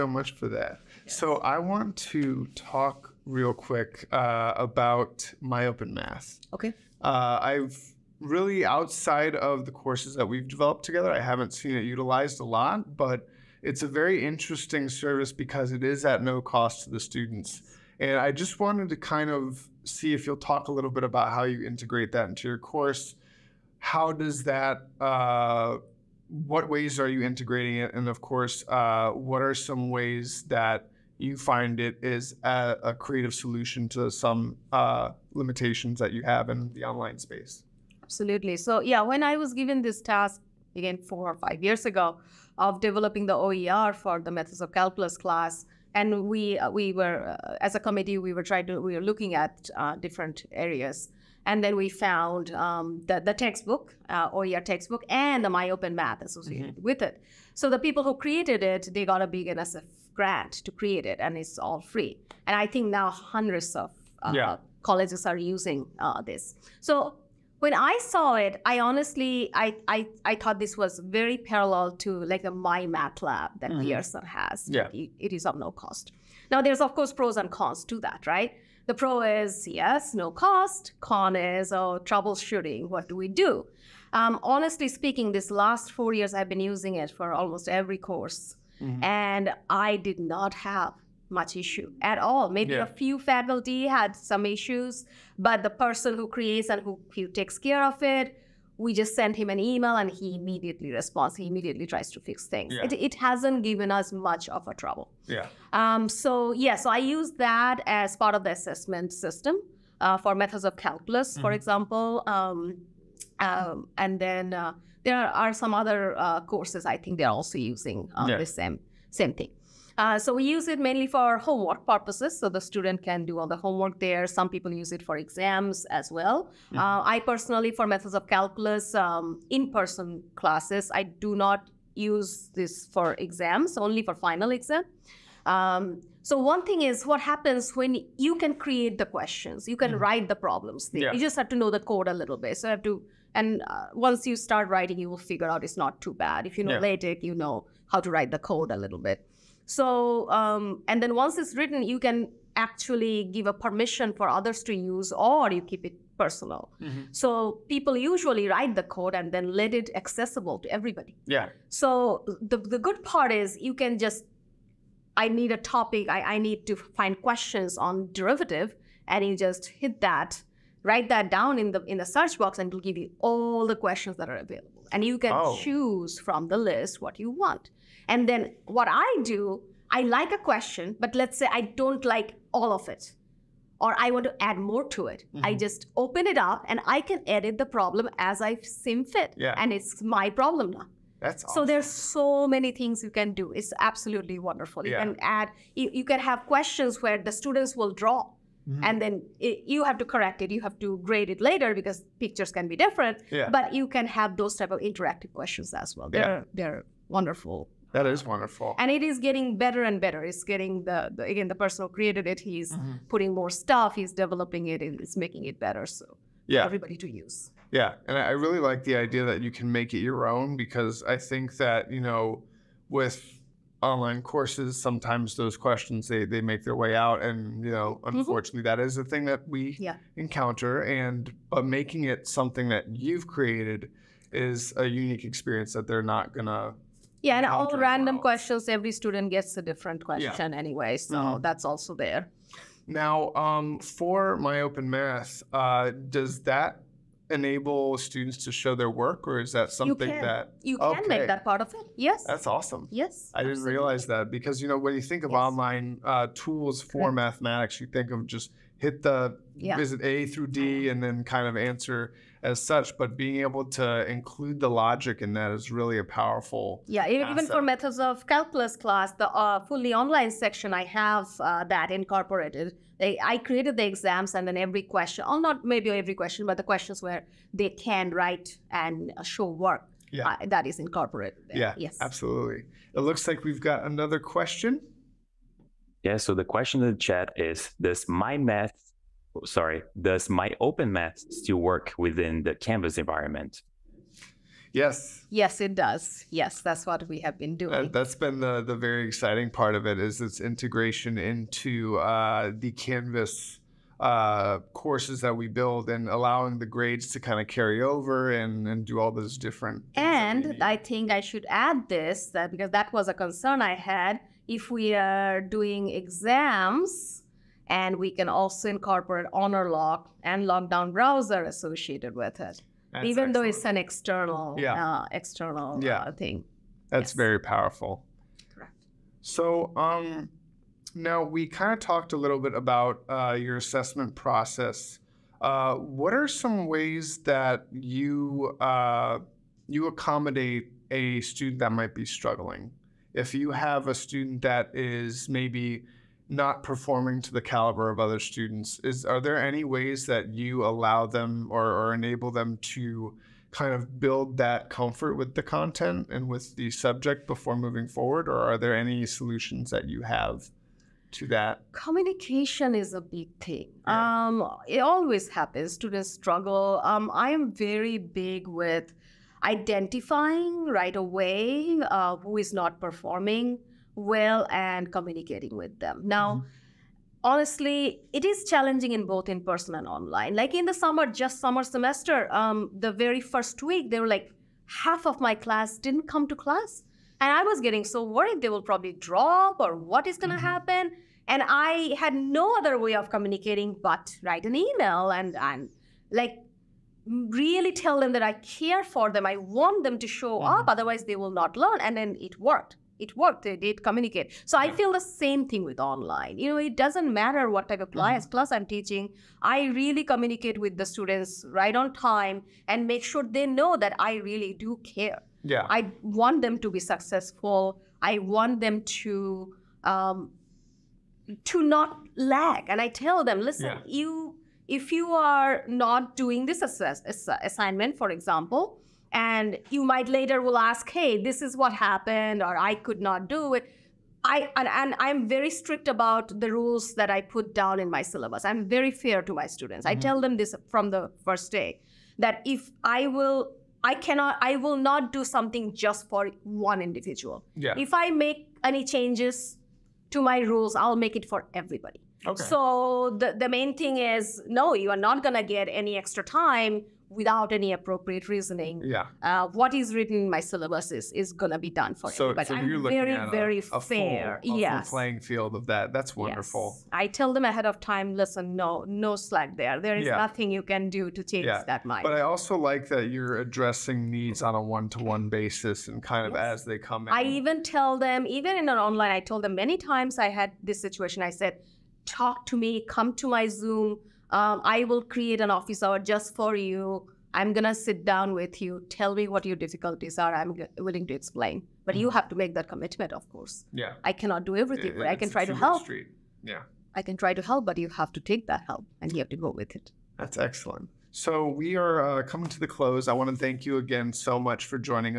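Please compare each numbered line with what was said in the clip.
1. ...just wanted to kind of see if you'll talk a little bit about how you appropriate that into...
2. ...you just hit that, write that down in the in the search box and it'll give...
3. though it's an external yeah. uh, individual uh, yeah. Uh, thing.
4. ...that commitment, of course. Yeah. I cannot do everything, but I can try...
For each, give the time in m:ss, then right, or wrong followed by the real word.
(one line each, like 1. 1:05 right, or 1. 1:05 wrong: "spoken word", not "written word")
1. 0:18 wrong: "integrate", not "appropriate"
2. 2:49 right
3. 5:23 wrong: "external", not "individual"
4. 8:12 right.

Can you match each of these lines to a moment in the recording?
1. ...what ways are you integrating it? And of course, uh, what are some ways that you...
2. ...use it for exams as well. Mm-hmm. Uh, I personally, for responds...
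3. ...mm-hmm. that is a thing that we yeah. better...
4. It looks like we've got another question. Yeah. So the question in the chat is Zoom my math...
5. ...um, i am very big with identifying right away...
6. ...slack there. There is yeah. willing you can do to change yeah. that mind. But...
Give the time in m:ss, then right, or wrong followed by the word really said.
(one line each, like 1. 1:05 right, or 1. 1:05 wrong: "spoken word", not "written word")
1. 0:26 right
2. 2:04 wrong: "methods", not "responds"
3. 3:48 wrong: "encounter", not "better"
4. 4:42 wrong: "Does", not "Zoom"
5. 6:06 right
6. 7:49 wrong: "nothing", not "willing".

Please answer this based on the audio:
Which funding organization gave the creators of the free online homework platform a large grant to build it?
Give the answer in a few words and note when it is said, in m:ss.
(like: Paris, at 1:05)
NSF, at 0:59.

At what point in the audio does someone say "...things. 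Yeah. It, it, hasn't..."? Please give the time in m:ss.
1:42.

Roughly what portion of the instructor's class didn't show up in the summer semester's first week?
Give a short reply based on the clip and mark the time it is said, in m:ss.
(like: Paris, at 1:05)
half, at 6:24.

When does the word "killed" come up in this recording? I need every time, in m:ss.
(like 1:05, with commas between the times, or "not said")
not said.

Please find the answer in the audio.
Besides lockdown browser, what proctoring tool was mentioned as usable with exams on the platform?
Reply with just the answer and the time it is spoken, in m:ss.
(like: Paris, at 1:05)
Honorlock, at 5:19.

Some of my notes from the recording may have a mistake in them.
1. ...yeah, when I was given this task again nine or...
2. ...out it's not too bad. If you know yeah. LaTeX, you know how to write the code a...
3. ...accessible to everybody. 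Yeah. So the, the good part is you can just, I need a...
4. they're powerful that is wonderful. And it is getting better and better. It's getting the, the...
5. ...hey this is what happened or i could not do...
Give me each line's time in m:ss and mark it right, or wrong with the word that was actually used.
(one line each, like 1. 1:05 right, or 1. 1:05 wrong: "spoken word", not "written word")
1. 0:38 wrong: "four", not "nine"
2. 2:25 right
3. 2:39 right
4. 3:26 wrong: "wonderful", not "powerful"
5. 7:10 right.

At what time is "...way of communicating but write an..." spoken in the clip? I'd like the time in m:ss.
6:32.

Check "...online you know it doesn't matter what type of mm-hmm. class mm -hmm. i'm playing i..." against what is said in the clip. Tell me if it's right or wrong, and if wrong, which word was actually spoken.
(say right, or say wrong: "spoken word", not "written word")
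wrong: "teaching", not "playing".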